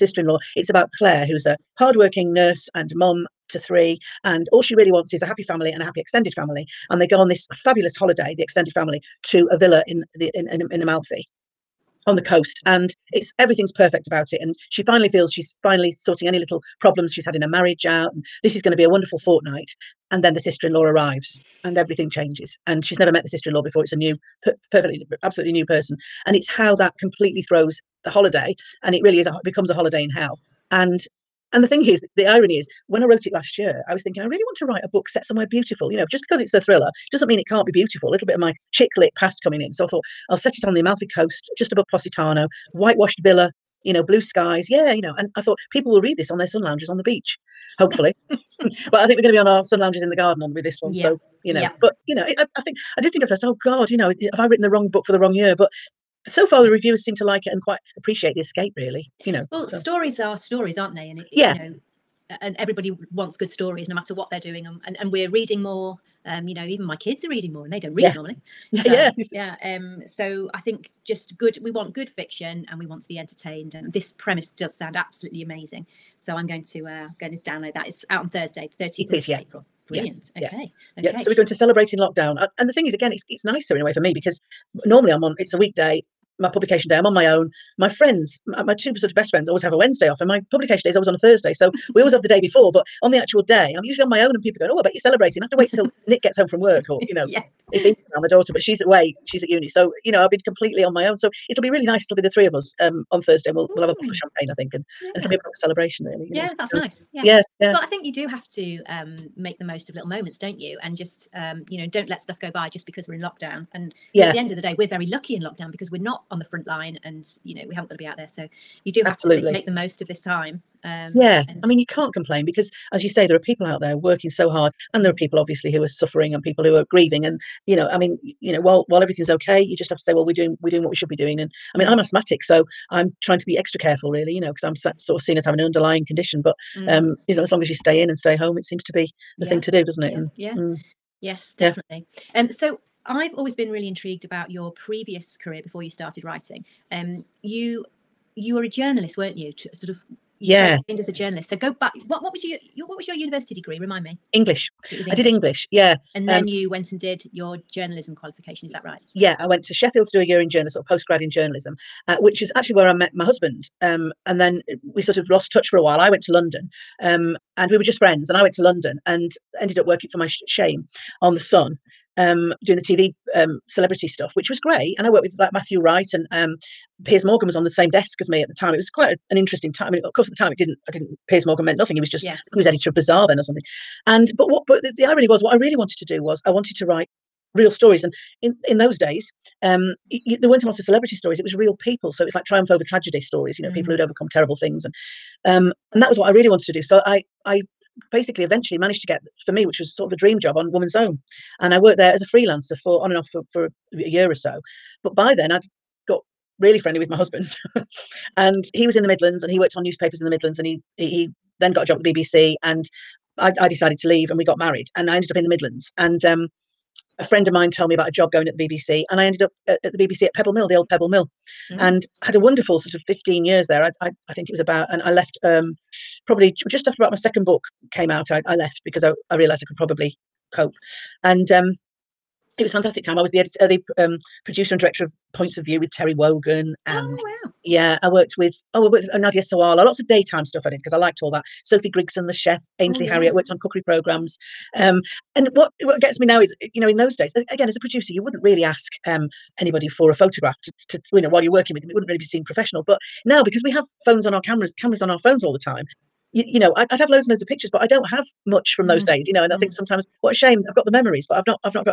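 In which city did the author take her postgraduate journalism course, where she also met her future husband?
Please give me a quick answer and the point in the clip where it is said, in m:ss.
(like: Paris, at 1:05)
Sheffield, at 2:39.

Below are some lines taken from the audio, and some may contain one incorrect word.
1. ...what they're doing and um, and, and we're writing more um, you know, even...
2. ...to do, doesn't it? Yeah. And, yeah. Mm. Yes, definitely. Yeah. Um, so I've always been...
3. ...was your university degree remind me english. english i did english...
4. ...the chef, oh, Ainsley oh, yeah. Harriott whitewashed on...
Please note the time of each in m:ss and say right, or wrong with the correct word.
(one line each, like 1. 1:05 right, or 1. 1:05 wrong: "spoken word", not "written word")
1. 1:04 wrong: "reading", not "writing"
2. 2:19 right
3. 2:32 right
4. 4:02 wrong: "worked", not "whitewashed".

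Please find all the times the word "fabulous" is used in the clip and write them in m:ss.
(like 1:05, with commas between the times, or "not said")
0:07.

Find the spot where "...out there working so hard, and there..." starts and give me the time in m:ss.
2:03.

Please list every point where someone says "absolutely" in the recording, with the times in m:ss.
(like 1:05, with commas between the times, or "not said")
0:25, 1:14, 1:59.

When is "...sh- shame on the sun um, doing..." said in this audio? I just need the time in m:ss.
2:50.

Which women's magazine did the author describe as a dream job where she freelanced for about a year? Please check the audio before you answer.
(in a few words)
Woman's Own.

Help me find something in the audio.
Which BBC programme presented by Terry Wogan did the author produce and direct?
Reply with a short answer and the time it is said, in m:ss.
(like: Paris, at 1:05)
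Points of View, at 3:55.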